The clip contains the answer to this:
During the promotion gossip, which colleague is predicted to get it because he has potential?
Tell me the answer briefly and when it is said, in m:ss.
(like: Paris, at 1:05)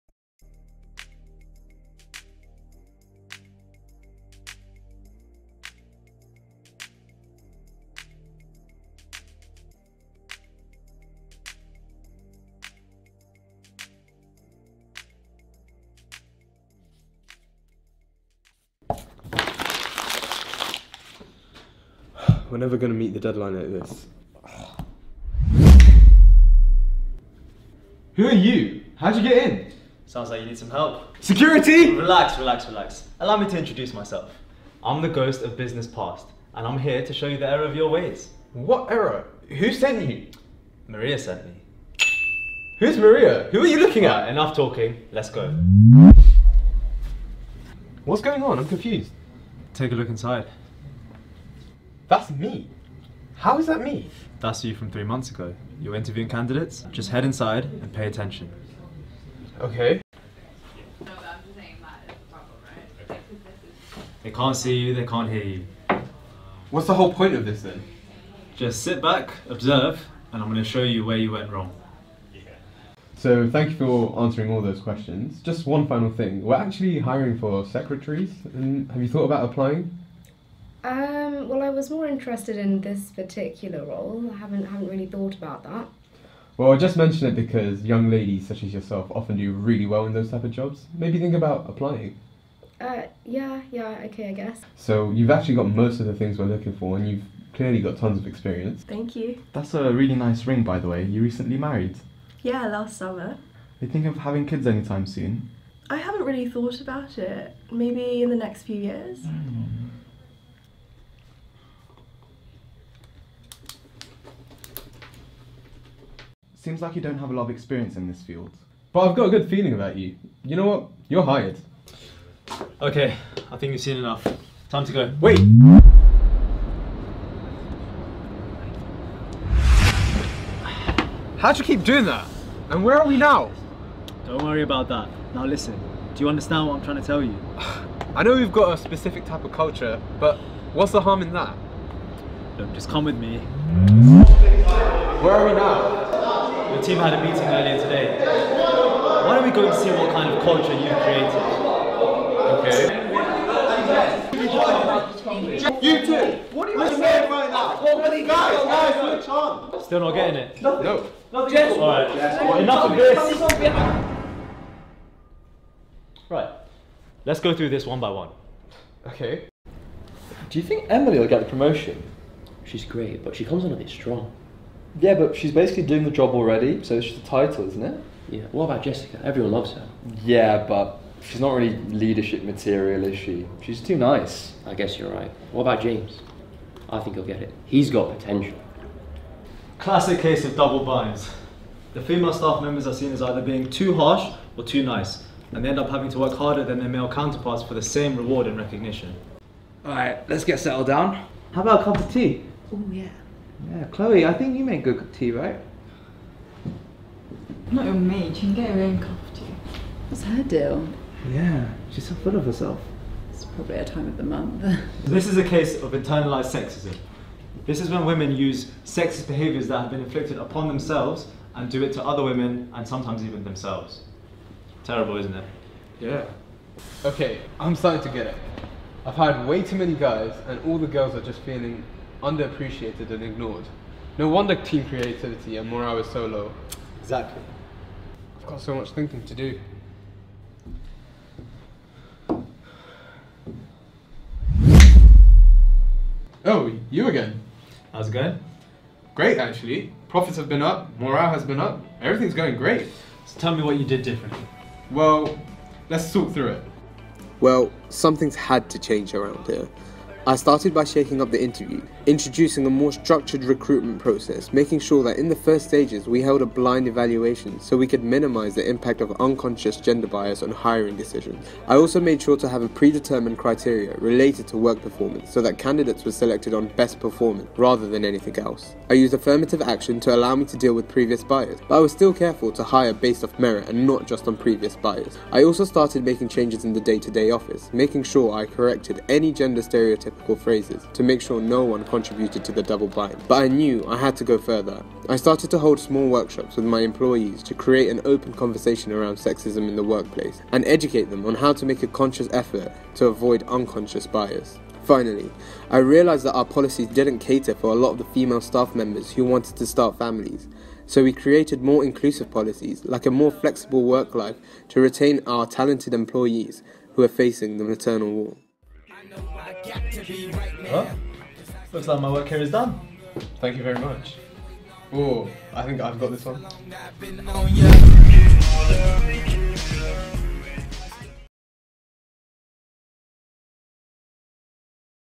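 James, at 3:05.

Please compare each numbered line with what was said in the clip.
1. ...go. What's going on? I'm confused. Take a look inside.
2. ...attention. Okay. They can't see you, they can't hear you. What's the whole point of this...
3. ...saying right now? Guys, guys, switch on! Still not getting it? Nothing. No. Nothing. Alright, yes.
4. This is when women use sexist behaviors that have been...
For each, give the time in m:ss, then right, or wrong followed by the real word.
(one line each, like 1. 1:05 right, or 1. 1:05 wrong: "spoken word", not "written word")
1. 0:45 right
2. 0:58 right
3. 2:36 right
4. 3:37 right.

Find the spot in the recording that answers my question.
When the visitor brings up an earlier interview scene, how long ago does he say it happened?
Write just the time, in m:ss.
0:54.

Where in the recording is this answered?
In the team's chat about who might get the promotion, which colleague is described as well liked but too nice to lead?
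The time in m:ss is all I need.
2:58.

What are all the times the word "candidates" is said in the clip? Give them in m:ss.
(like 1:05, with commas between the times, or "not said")
0:56, 4:35.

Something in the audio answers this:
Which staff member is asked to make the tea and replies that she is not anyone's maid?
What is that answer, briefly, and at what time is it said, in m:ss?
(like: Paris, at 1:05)
Chloe, at 3:23.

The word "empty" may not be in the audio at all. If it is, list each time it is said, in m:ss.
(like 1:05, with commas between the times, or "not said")
not said.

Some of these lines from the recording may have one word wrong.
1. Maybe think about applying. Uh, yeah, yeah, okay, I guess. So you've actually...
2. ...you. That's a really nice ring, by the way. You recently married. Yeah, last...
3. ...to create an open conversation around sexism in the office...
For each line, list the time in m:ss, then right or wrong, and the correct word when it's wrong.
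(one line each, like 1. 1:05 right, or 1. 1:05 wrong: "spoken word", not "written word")
1. 1:30 right
2. 1:39 right
3. 4:57 wrong: "workplace", not "office".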